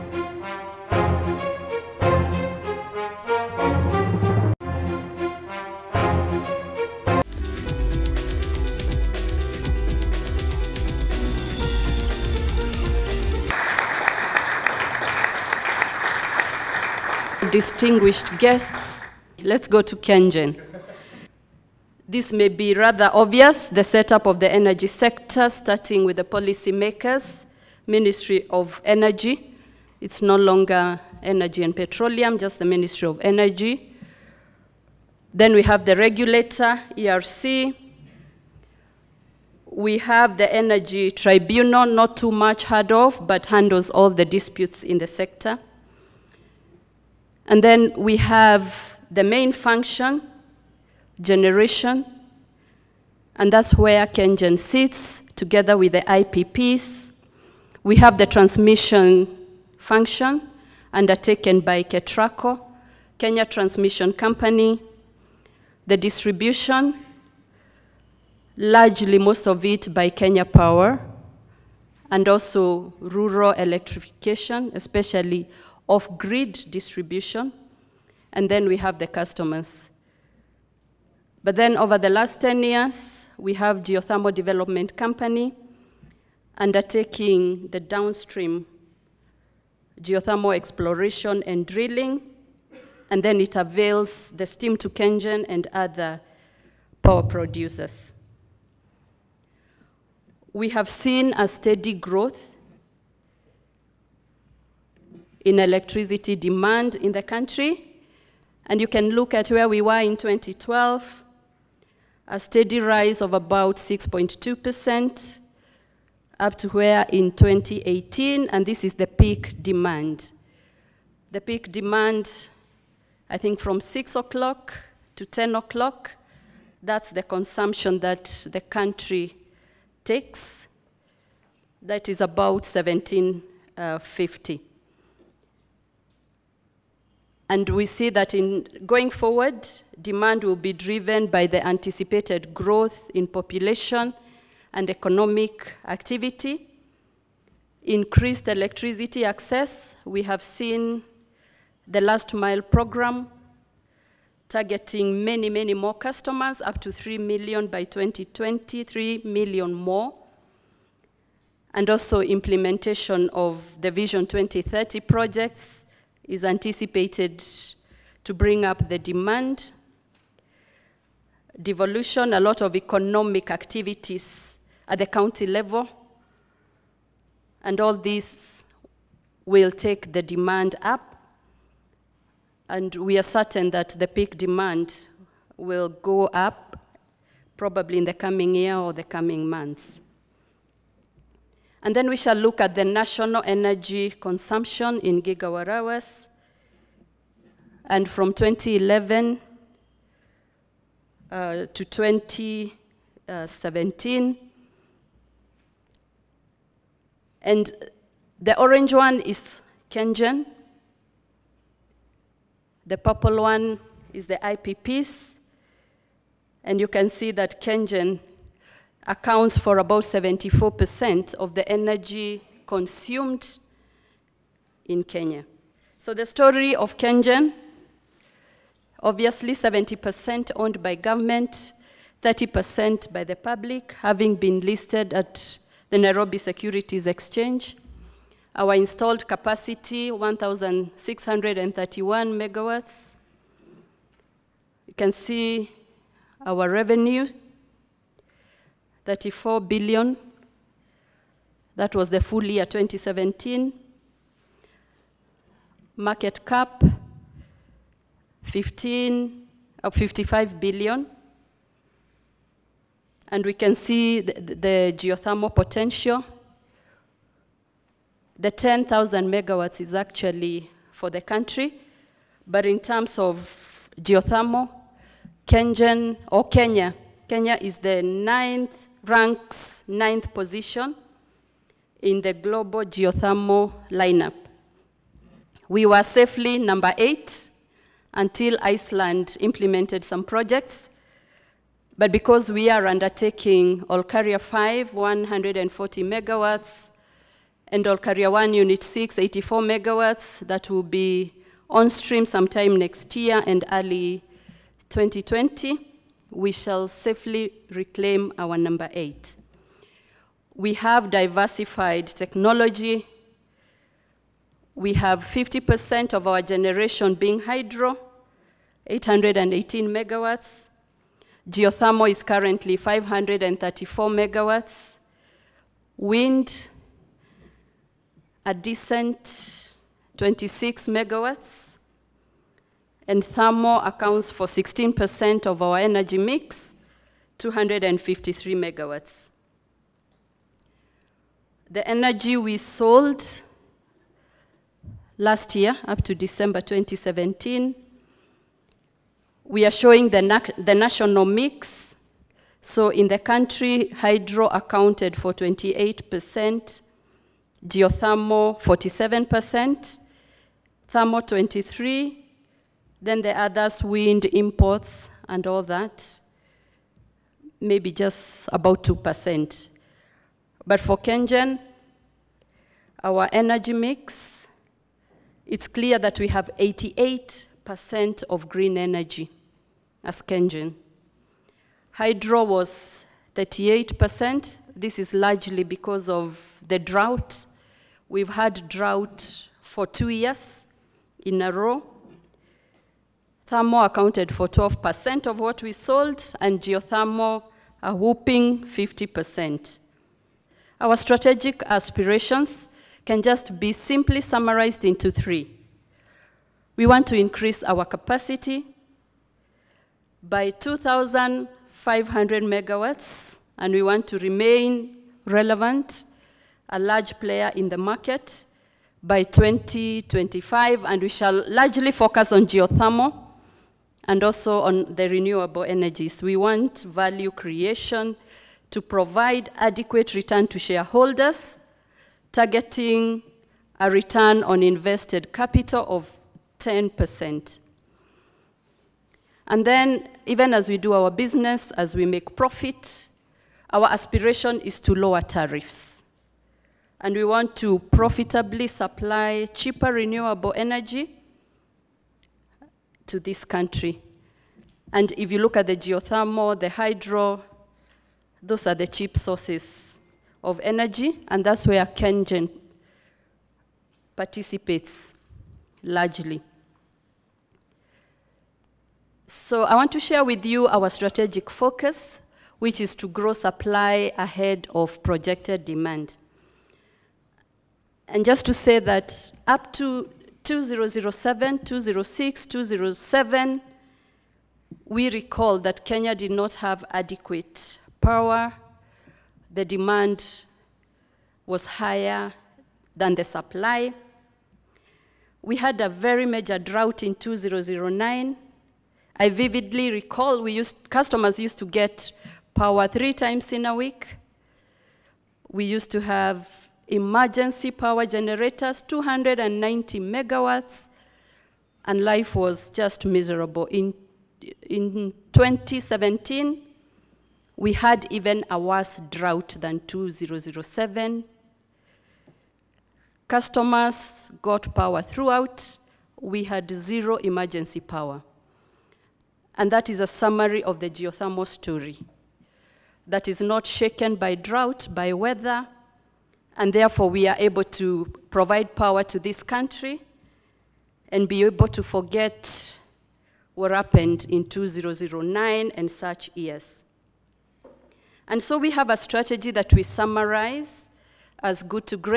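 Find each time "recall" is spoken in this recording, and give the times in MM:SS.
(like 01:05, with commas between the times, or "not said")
08:05, 08:19.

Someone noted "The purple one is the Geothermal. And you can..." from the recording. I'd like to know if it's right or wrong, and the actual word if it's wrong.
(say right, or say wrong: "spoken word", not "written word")
wrong: "IPPs", not "Geothermal".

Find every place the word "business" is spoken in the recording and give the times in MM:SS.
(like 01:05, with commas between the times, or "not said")
07:21.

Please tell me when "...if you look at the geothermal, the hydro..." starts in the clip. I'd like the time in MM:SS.
07:35.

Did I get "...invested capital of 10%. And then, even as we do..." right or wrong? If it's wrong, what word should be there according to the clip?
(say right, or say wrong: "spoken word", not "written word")
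right.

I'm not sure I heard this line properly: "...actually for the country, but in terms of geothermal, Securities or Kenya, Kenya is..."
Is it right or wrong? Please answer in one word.
wrong.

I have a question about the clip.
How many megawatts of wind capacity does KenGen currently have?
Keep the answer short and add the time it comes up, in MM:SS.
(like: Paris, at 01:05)
26 megawatts, at 05:30.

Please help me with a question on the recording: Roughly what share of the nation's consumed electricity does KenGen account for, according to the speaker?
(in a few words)
74%.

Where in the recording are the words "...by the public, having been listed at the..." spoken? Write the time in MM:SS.
03:53.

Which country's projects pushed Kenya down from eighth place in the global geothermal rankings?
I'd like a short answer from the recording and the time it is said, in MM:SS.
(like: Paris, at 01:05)
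Iceland, at 04:48.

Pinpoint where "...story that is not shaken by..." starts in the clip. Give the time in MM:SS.
08:51.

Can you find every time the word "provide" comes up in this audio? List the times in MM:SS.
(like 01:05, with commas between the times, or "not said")
07:08, 08:58.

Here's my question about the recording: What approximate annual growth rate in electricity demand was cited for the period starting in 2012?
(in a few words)
6.2%.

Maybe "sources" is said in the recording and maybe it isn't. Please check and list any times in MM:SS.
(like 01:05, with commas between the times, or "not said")
07:39.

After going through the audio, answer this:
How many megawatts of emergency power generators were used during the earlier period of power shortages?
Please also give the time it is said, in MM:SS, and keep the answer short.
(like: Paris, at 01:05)
290 megawatts, at 08:28.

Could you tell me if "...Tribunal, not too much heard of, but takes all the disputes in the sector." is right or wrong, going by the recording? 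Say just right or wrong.
wrong.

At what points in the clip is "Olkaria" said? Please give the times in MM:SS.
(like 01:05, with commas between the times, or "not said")
04:53, 04:57.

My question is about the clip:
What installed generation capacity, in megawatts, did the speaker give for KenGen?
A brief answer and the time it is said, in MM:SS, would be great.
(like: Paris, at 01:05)
1,631 megawatts, at 04:00.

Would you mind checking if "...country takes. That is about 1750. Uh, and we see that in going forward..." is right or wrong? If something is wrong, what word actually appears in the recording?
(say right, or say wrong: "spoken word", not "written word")
right.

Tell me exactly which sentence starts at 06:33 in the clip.
Thermo accounted for 12% of what we sold, and geothermal a whooping 50%.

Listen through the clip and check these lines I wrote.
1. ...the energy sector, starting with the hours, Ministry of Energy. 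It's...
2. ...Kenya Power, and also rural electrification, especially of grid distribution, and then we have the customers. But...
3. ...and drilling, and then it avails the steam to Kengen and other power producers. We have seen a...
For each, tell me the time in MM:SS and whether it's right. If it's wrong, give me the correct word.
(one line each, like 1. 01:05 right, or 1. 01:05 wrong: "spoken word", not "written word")
1. 00:24 wrong: "policymakers", not "hours"
2. 01:10 right
3. 01:31 right.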